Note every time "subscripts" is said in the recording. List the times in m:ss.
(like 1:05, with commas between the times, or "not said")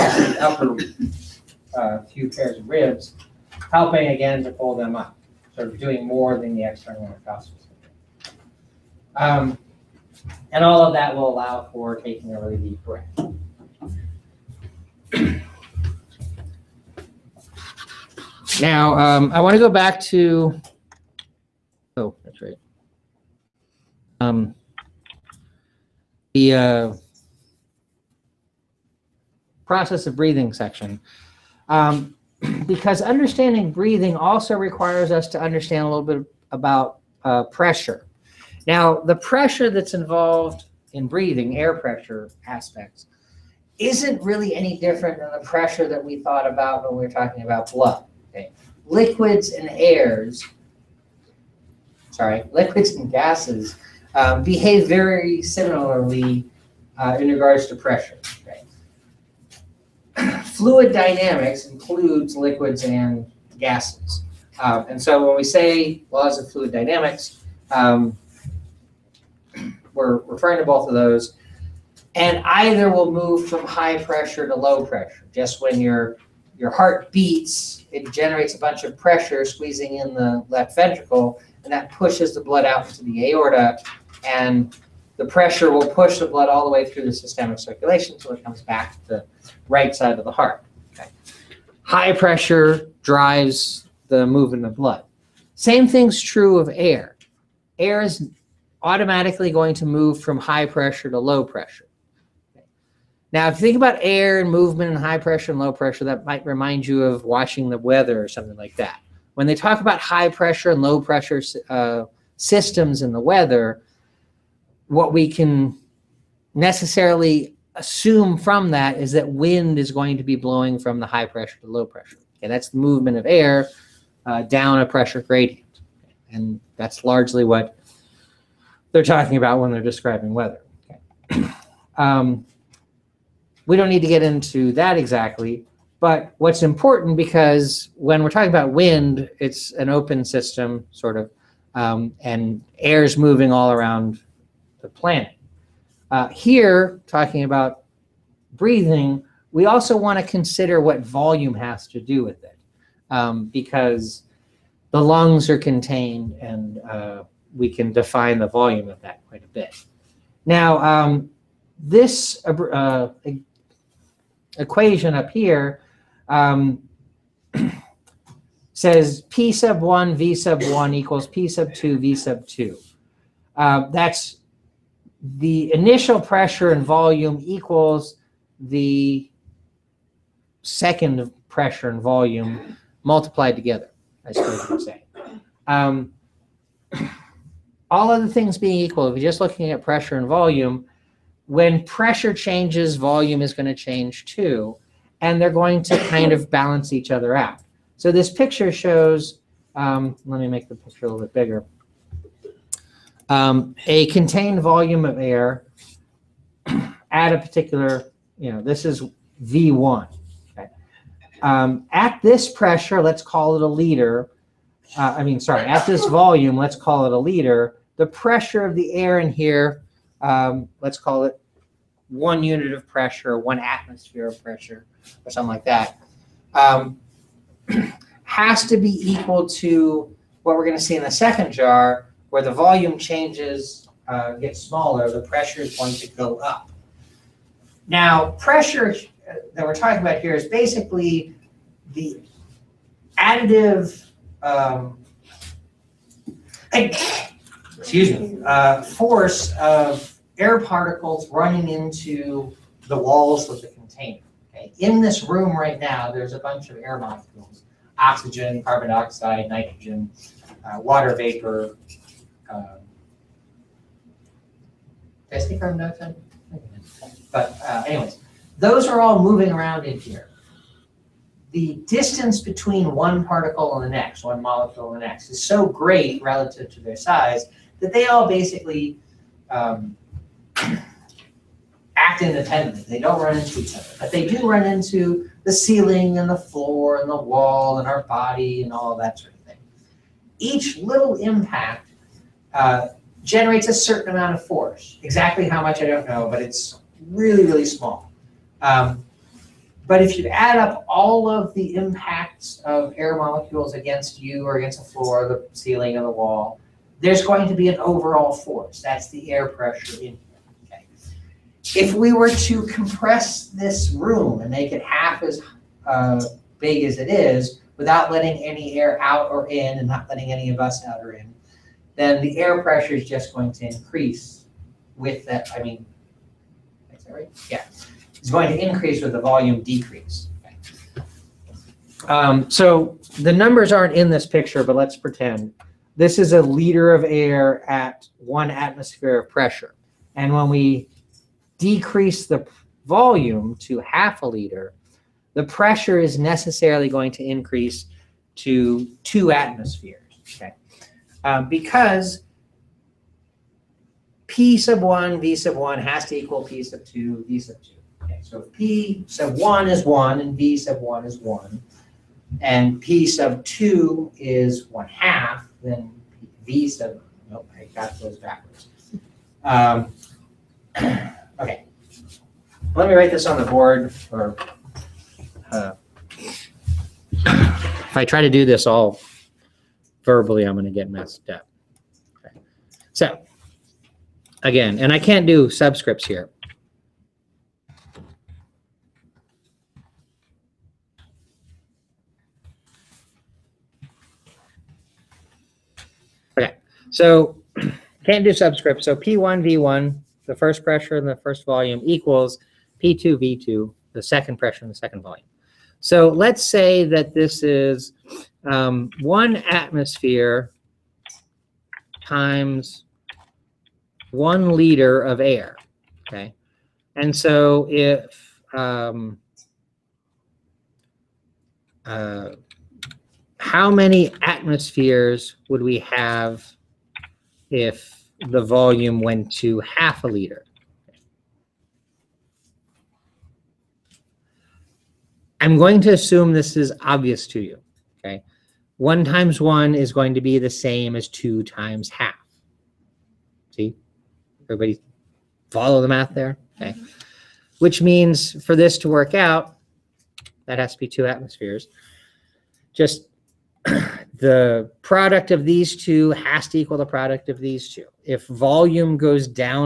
6:25, 6:38.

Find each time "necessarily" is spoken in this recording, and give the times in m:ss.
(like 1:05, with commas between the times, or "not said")
1:56, 5:46.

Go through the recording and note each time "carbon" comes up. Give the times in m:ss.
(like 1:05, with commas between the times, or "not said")
4:18.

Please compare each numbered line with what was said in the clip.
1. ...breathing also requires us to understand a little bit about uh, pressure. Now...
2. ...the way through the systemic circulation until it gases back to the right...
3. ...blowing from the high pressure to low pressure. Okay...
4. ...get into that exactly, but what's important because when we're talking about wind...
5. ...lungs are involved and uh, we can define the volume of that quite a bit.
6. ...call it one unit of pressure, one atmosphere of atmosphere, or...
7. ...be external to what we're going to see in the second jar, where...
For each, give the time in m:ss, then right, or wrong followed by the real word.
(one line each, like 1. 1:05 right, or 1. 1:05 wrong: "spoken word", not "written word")
1. 0:33 right
2. 1:26 wrong: "comes", not "gases"
3. 2:00 right
4. 2:14 right
5. 2:35 wrong: "contained", not "involved"
6. 3:40 wrong: "pressure", not "atmosphere"
7. 3:48 wrong: "equal", not "external".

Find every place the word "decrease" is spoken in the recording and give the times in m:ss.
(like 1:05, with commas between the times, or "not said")
5:29, 5:41.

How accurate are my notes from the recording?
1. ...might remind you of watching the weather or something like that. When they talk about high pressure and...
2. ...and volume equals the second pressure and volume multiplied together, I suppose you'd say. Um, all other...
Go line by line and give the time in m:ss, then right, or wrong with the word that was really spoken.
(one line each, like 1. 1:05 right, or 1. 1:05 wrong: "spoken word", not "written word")
1. 1:46 right
2. 2:56 right.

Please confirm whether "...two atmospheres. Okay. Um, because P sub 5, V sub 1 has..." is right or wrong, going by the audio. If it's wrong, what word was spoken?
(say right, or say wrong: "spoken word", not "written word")
wrong: "1", not "5".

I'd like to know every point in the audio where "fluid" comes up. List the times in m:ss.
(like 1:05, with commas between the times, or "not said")
1:00, 1:06.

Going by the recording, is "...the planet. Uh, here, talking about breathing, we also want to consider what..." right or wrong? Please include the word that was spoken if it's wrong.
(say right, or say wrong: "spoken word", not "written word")
right.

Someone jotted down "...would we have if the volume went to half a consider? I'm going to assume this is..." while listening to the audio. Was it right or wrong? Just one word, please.
wrong.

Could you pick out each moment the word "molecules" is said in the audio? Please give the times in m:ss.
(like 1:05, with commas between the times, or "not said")
4:16, 4:34, 5:03.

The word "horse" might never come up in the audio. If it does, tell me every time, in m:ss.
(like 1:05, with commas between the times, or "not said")
not said.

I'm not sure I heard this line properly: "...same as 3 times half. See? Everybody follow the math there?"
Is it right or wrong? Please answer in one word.
wrong.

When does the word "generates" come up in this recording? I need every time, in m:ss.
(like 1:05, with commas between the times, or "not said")
1:18, 4:53.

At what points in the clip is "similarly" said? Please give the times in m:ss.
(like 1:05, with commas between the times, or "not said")
0:55.